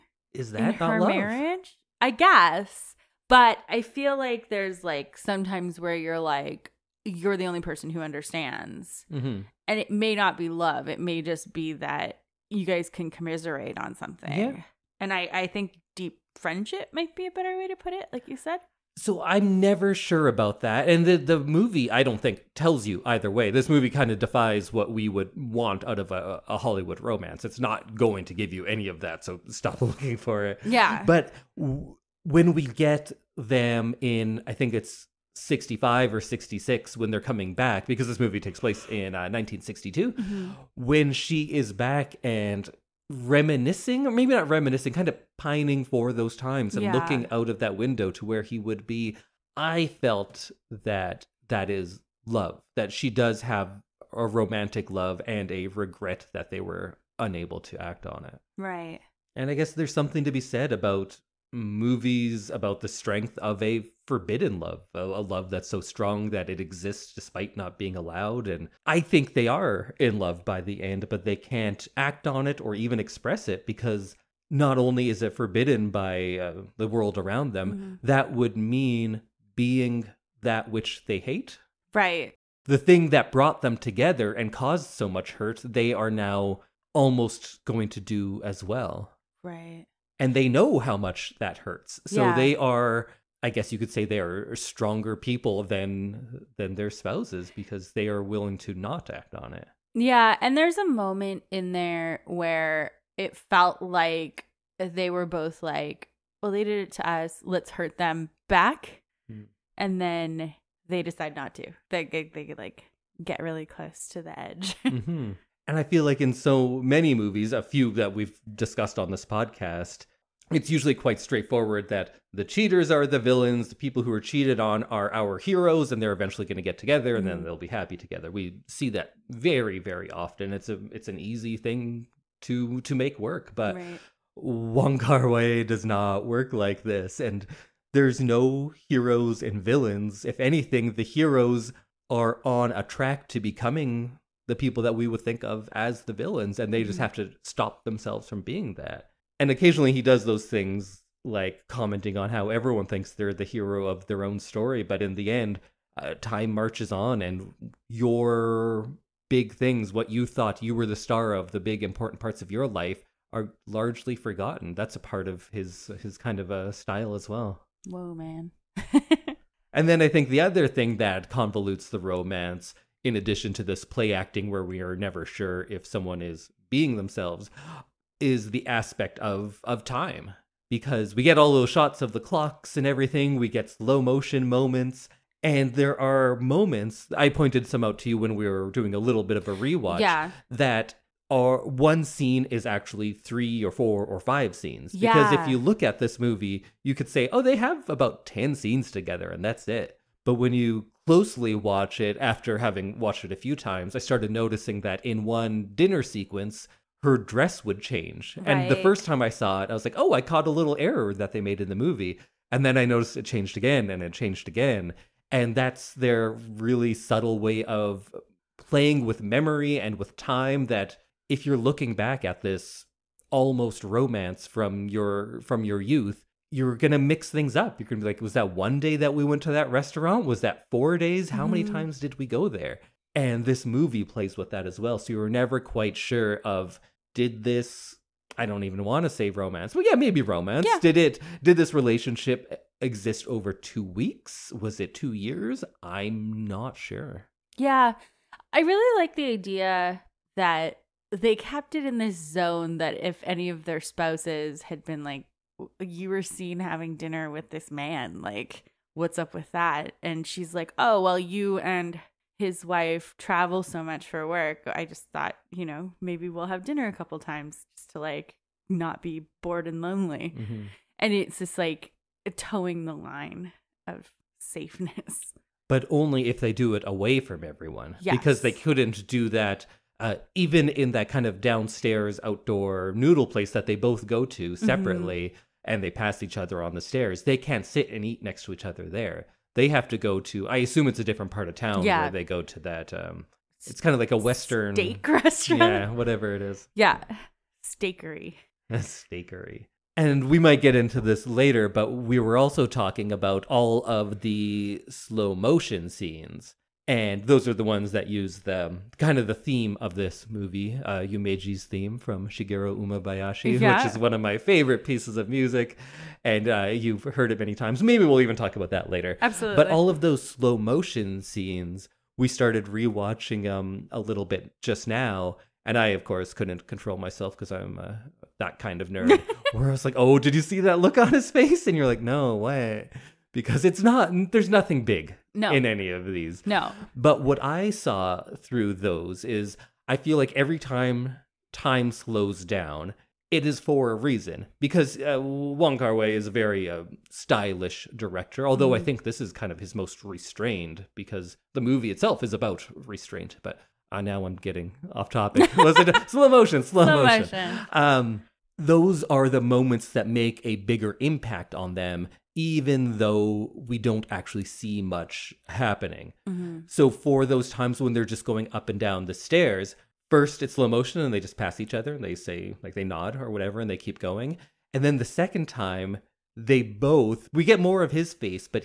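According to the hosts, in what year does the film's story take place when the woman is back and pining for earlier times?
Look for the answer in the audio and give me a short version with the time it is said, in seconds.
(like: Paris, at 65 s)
1962, at 39 s.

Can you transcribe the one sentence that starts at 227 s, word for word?
You're gonna be like, was that one day that we went to that restaurant?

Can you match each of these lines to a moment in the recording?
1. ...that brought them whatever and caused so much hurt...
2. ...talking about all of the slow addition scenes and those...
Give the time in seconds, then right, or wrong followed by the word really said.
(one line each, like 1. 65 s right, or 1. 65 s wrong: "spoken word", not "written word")
1. 83 s wrong: "together", not "whatever"
2. 302 s wrong: "motion", not "addition".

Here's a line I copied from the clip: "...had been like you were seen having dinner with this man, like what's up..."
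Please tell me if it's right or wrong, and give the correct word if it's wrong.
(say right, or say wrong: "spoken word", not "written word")
right.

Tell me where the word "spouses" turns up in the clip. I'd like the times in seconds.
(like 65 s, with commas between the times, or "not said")
96 s, 253 s.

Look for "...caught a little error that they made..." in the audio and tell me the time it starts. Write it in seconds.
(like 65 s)
210 s.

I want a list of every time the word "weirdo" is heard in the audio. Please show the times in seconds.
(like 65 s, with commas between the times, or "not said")
not said.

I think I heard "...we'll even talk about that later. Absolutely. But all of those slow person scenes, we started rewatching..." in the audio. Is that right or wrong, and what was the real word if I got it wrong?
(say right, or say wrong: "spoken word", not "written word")
wrong: "motion", not "person".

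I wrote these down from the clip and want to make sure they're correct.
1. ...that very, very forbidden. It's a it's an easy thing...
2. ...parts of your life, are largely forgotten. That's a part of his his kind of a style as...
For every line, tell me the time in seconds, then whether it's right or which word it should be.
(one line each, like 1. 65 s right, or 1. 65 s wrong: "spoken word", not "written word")
1. 128 s wrong: "often", not "forbidden"
2. 162 s right.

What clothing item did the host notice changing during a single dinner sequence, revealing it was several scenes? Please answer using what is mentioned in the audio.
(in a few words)
Her dress.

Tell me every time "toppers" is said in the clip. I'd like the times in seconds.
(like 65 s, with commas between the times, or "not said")
not said.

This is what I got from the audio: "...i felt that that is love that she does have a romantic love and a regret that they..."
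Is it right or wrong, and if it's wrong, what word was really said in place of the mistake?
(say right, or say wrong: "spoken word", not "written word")
right.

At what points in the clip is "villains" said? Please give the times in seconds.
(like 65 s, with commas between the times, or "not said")
123 s, 139 s, 146 s.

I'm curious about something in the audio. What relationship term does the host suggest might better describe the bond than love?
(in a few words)
Deep friendship.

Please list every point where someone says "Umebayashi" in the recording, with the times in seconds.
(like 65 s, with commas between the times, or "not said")
312 s.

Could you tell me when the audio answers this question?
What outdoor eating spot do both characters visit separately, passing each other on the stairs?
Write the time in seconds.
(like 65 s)
282 s.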